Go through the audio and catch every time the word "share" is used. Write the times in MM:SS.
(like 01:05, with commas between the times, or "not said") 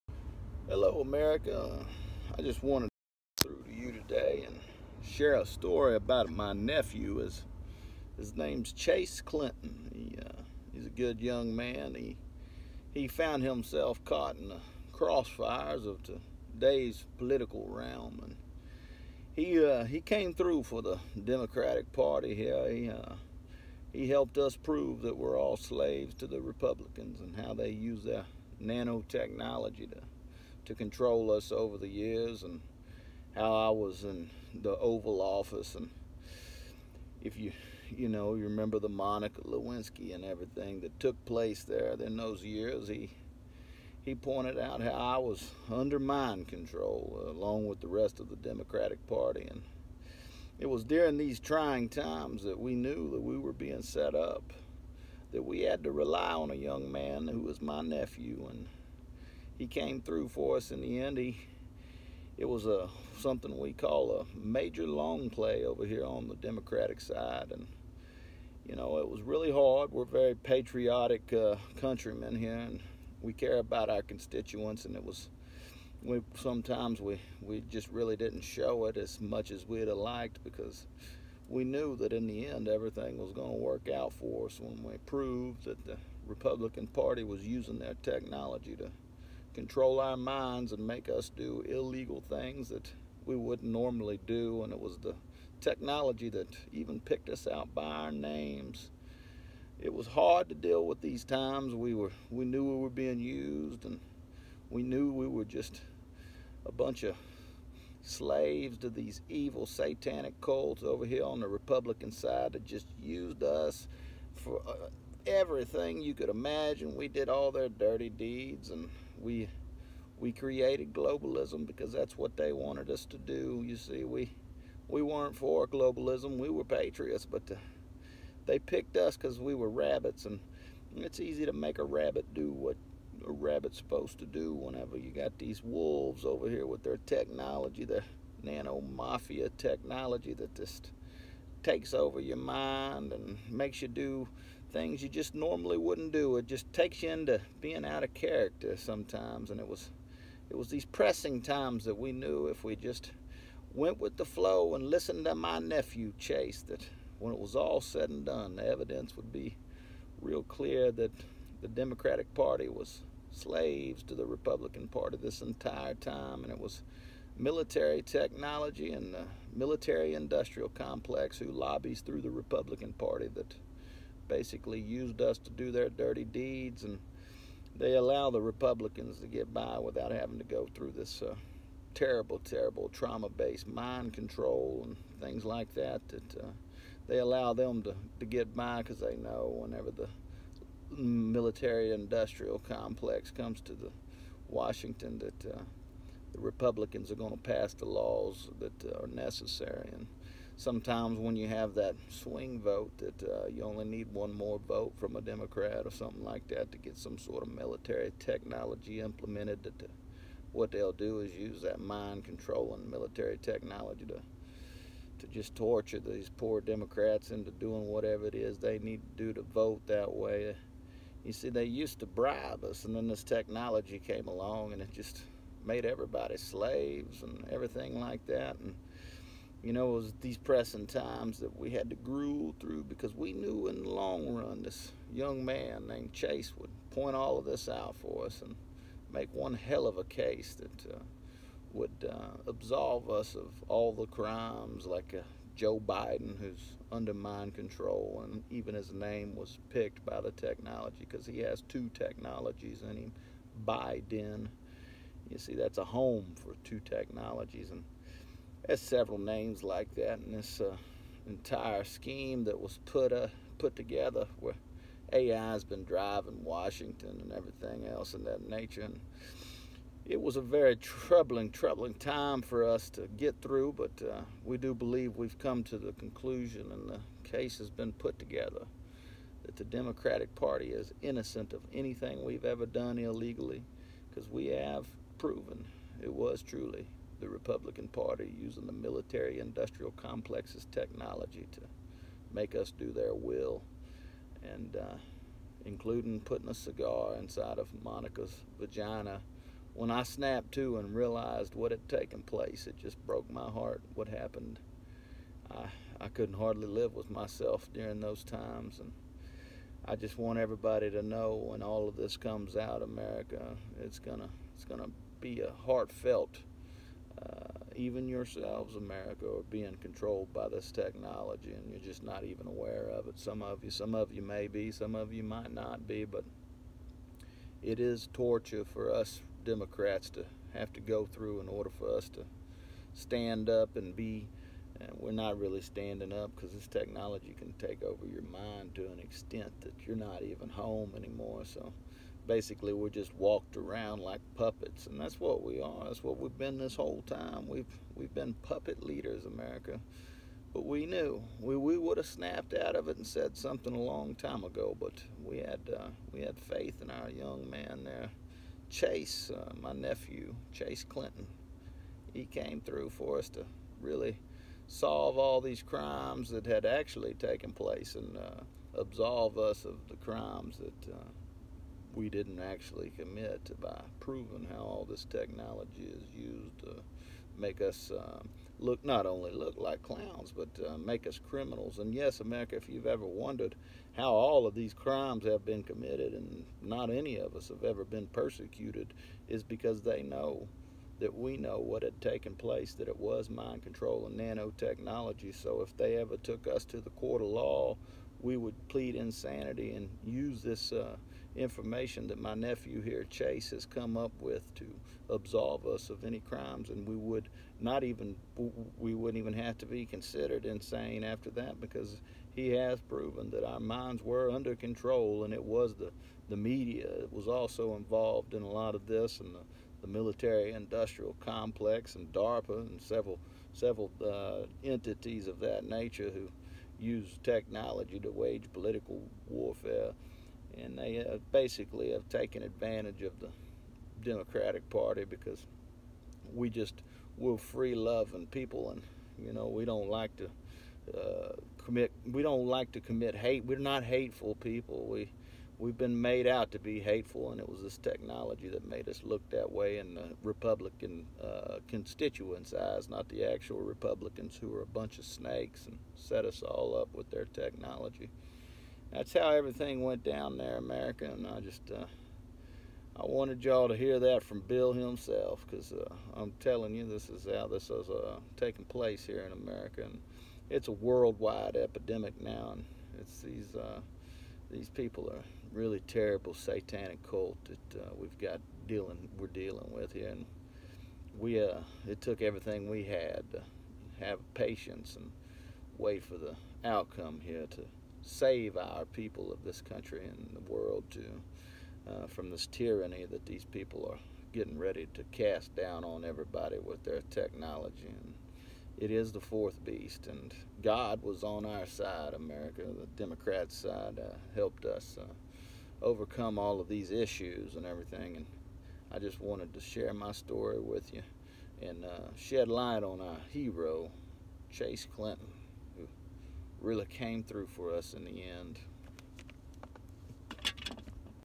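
00:05, 08:29.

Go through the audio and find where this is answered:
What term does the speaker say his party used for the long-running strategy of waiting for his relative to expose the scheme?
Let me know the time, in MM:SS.
01:04.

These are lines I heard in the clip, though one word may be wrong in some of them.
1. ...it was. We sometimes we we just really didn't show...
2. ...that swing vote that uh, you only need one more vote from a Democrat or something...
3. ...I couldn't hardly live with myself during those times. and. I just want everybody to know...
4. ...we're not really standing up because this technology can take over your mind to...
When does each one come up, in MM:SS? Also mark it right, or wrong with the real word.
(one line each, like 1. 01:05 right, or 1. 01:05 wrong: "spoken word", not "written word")
1. 01:14 right
2. 03:21 right
3. 05:05 right
4. 05:34 right.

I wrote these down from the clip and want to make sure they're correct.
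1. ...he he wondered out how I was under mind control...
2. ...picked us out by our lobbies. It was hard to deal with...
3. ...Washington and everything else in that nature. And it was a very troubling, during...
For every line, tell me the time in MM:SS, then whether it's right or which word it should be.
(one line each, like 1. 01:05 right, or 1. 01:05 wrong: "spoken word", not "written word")
1. 00:42 wrong: "pointed", not "wondered"
2. 01:36 wrong: "names", not "lobbies"
3. 04:26 wrong: "troubling", not "during".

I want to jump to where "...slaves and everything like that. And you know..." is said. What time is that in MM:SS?
03:46.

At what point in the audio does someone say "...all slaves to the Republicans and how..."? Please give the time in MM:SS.
00:25.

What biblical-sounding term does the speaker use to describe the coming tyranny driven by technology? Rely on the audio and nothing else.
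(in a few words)
the fourth beast.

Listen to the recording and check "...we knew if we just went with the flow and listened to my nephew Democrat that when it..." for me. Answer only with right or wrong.
wrong.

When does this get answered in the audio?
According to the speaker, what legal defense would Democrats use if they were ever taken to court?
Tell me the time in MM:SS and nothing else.
06:38.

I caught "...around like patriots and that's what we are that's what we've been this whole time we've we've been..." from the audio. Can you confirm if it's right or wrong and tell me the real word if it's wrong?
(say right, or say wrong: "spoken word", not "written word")
wrong: "puppets", not "patriots".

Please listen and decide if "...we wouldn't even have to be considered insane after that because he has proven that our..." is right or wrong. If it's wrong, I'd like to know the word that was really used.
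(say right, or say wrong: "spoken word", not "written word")
right.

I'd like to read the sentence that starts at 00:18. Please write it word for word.
And he, uh, he came through for the Democratic Party here.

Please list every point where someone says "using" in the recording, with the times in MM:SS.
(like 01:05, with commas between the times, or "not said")
01:27, 04:48.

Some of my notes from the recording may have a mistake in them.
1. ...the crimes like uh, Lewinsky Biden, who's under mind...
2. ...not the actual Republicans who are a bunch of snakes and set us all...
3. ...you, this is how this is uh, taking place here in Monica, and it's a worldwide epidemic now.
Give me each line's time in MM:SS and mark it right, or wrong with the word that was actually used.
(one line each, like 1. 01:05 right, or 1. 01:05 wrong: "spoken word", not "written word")
1. 04:03 wrong: "Joe", not "Lewinsky"
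2. 07:32 right
3. 07:46 wrong: "America", not "Monica".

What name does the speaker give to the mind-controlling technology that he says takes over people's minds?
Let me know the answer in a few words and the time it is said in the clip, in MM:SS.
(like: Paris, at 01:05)
nano mafia technology, at 02:18.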